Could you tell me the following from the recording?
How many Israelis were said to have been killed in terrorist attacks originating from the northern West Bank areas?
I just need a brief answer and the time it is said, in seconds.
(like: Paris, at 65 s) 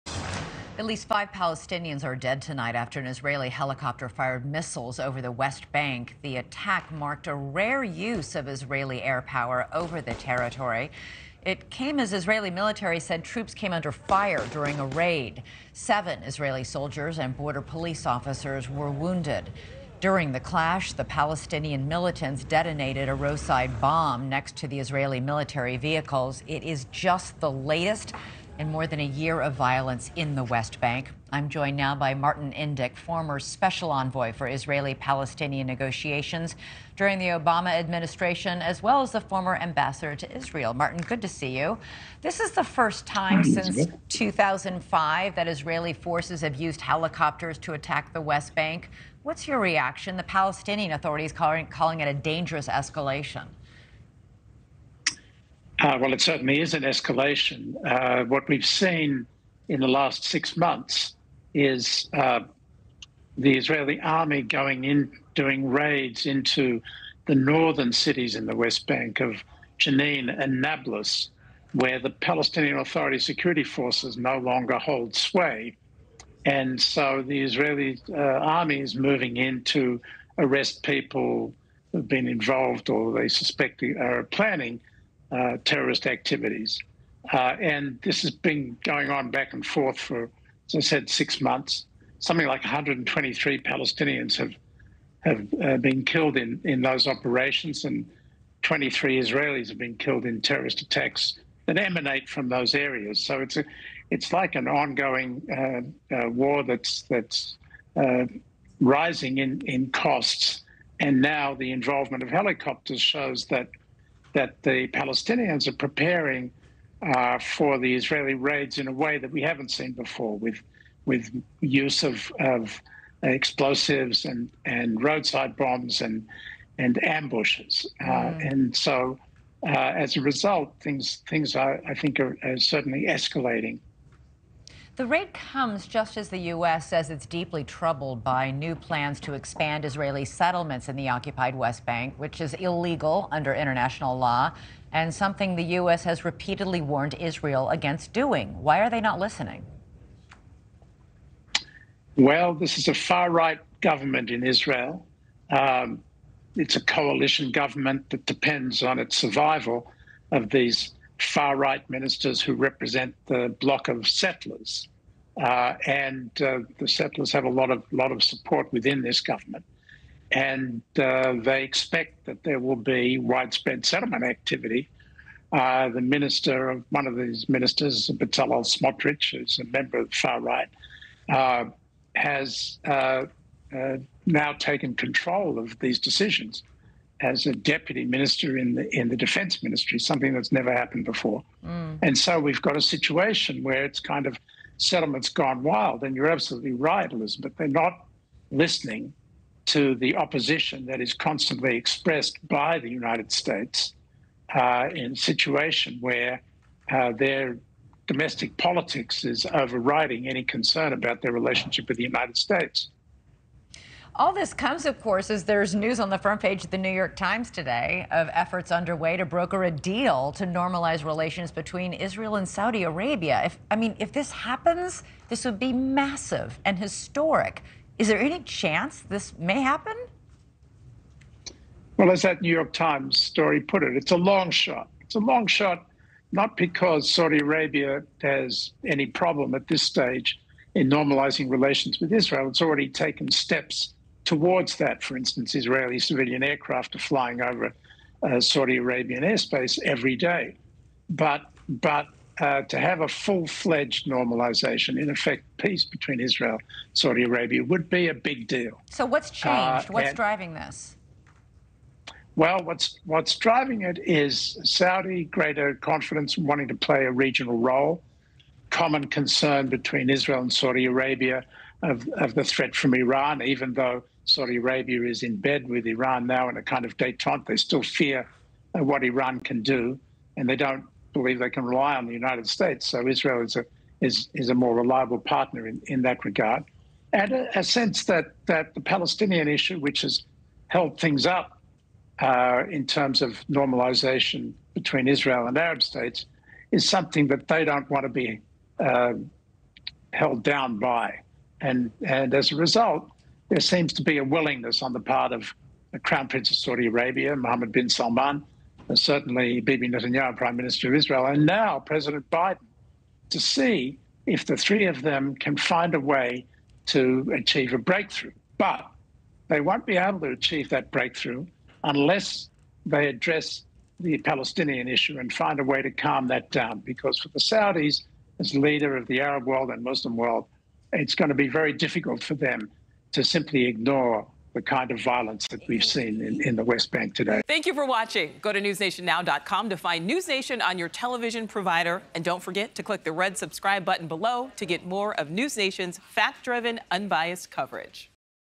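23, at 98 s.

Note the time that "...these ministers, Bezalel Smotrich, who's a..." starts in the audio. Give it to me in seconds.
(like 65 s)
177 s.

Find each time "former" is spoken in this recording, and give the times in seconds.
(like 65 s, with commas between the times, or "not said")
32 s, 39 s.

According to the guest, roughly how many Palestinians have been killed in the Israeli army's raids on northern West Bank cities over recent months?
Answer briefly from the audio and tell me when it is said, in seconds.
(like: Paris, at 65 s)
123, at 92 s.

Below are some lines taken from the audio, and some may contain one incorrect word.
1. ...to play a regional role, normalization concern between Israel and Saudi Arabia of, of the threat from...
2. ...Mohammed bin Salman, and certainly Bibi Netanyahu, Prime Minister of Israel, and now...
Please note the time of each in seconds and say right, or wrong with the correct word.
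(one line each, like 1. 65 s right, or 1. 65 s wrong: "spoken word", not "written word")
1. 266 s wrong: "common", not "normalization"
2. 307 s right.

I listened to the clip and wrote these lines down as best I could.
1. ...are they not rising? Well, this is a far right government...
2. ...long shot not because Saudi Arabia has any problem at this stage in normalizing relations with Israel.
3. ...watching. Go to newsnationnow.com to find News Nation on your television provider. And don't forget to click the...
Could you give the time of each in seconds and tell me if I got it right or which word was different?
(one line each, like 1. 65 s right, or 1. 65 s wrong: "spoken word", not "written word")
1. 148 s wrong: "listening", not "rising"
2. 235 s right
3. 337 s right.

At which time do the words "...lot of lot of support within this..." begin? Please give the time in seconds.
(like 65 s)
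167 s.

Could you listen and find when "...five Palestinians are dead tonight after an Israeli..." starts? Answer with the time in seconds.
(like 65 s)
1 s.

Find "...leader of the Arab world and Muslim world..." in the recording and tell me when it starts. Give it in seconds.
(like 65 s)
328 s.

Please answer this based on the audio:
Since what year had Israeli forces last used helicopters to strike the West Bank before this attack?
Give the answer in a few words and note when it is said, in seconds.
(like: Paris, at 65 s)
2005, at 44 s.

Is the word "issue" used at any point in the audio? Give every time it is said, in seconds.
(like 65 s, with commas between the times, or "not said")
289 s, 324 s.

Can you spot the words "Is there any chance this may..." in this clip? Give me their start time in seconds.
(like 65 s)
227 s.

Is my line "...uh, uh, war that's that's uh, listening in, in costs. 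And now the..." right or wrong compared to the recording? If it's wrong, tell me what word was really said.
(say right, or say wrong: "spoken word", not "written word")
wrong: "rising", not "listening".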